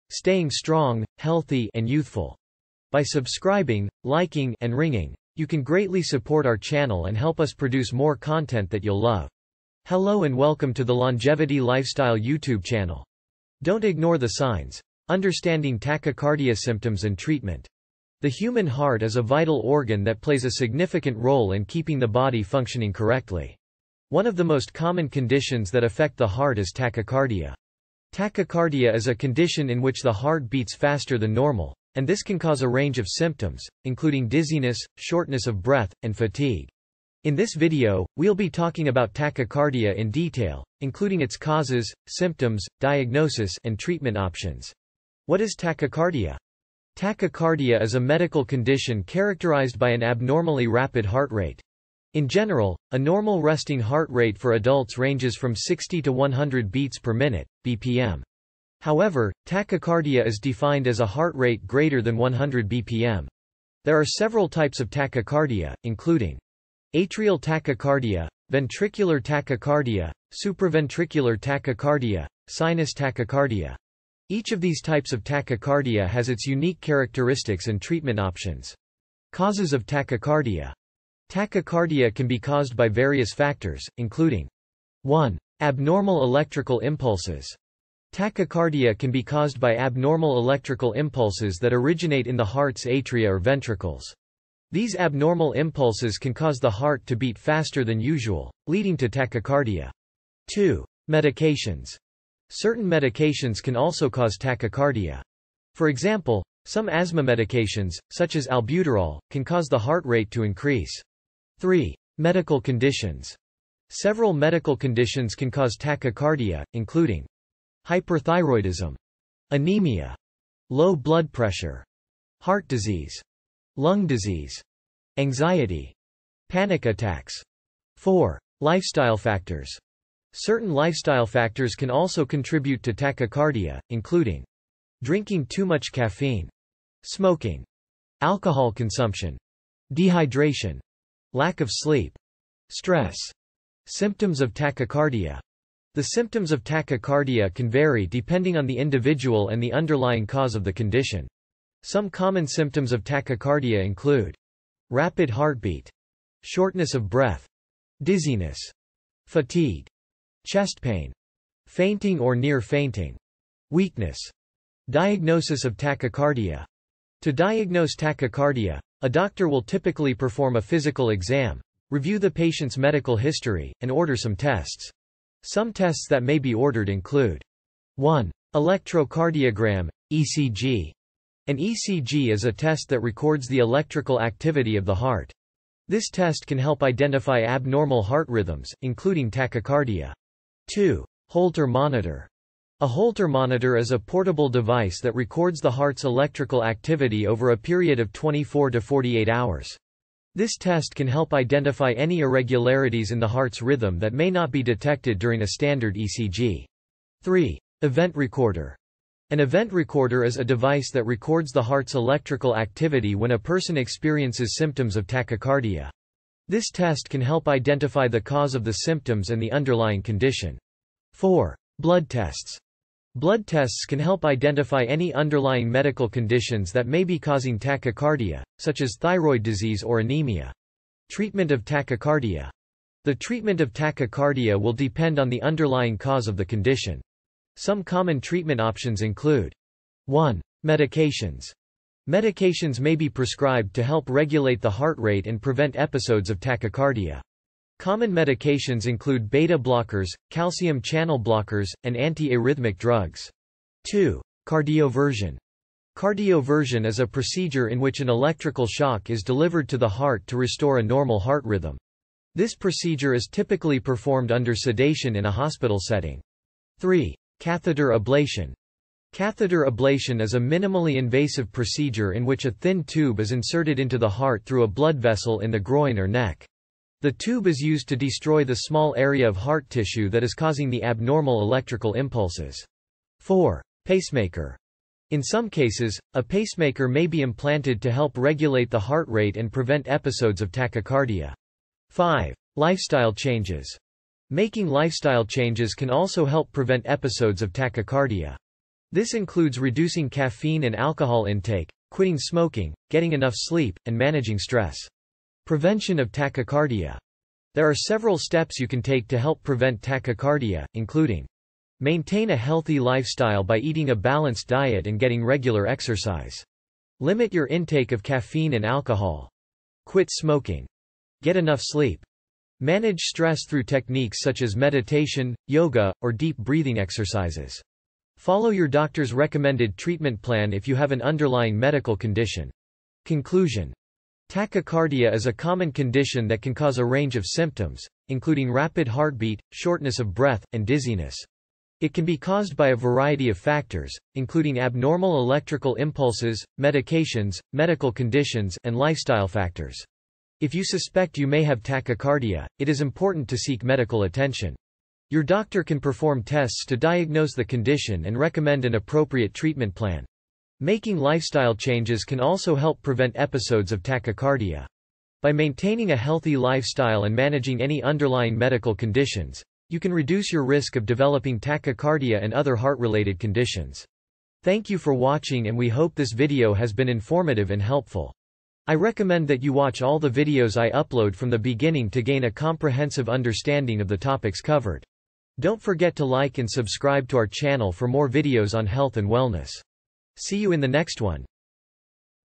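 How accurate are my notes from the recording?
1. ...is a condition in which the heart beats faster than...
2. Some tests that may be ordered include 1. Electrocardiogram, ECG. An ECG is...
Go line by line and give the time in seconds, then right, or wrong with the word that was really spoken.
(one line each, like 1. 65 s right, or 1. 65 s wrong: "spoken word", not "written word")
1. 28 s right
2. 175 s right.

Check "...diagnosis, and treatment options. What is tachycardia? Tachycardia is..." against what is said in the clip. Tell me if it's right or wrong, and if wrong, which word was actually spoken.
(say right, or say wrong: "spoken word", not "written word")
right.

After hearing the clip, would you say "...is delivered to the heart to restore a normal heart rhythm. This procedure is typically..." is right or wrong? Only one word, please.
right.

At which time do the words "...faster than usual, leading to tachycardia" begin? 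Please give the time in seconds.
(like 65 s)
97 s.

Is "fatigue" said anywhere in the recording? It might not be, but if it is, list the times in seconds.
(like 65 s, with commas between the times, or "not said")
36 s, 159 s.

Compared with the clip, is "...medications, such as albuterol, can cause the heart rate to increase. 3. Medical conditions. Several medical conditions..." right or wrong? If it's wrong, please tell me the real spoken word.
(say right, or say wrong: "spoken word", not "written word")
right.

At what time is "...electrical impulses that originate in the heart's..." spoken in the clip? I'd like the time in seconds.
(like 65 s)
90 s.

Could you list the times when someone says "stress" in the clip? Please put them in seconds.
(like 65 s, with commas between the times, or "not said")
142 s, 304 s, 322 s.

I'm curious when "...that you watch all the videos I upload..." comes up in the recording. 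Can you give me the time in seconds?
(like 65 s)
379 s.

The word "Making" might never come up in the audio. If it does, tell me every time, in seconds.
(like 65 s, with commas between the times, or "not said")
294 s, 360 s.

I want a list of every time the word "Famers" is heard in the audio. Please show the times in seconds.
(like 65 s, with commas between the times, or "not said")
not said.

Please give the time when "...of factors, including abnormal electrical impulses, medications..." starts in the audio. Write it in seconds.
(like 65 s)
343 s.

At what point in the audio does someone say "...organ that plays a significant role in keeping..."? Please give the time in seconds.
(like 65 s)
19 s.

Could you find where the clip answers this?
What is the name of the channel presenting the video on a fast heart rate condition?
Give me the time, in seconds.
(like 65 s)
10 s.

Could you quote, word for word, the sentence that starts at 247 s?
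Common medications include beta blockers, calcium channel blockers, and antiarrhythmic drugs.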